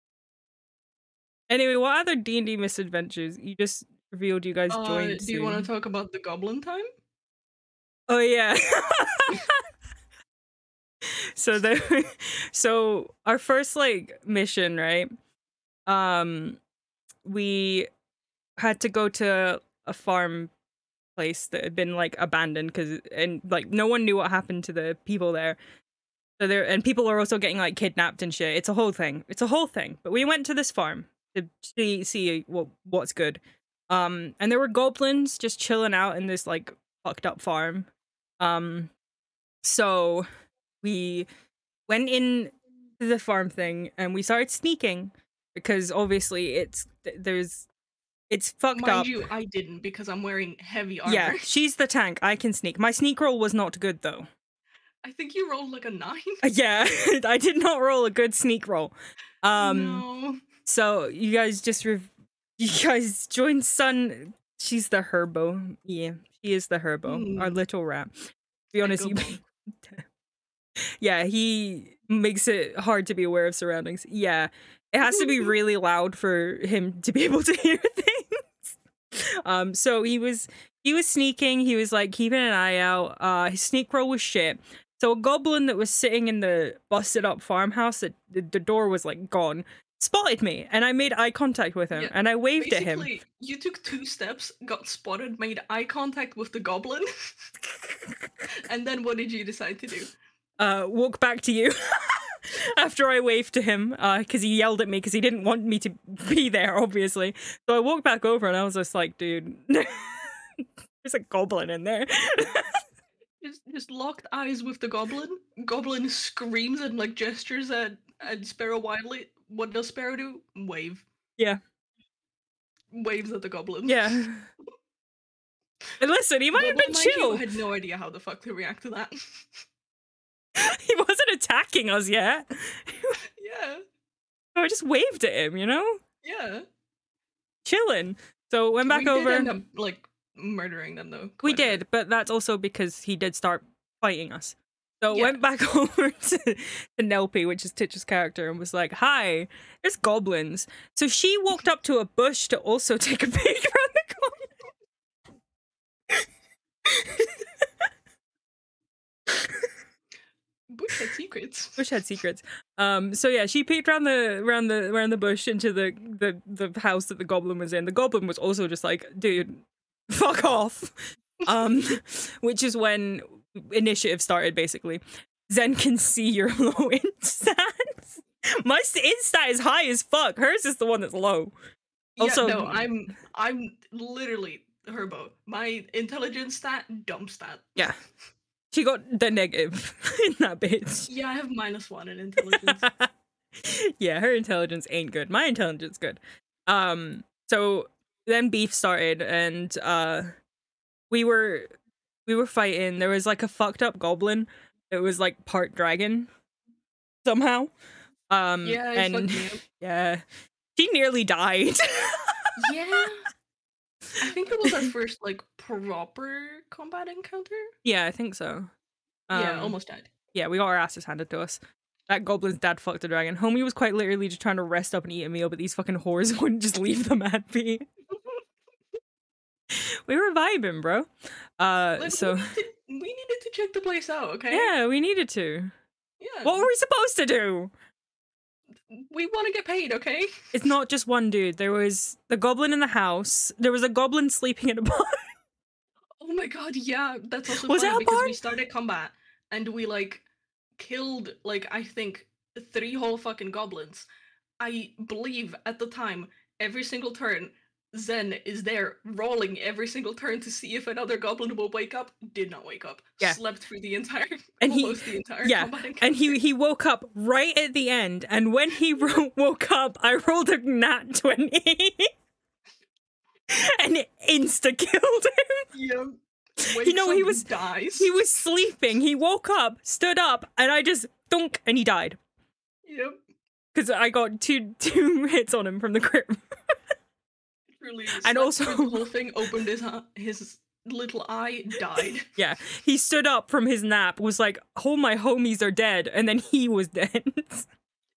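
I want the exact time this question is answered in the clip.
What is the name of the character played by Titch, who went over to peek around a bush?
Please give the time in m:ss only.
2:27.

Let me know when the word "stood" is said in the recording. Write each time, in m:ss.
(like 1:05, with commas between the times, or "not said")
4:39, 4:52.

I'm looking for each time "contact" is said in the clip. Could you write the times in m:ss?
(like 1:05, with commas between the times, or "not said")
1:31, 1:35.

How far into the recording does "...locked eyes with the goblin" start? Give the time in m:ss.
1:53.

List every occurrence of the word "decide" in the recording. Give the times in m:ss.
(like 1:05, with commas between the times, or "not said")
1:39.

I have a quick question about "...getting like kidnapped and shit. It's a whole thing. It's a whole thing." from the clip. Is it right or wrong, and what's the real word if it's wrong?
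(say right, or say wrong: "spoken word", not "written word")
right.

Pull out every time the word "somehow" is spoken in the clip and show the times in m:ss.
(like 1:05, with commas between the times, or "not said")
3:27.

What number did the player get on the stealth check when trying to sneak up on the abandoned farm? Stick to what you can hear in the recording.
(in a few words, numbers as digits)
9.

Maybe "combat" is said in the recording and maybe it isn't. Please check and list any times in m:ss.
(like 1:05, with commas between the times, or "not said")
3:36, 4:08.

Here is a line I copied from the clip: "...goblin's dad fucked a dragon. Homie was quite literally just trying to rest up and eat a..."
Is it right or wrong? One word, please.
right.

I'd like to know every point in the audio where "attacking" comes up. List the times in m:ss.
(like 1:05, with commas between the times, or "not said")
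2:11.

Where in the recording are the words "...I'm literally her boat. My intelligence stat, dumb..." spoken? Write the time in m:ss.
3:03.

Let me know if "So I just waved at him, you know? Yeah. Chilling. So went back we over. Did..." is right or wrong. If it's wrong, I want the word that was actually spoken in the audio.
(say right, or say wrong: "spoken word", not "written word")
right.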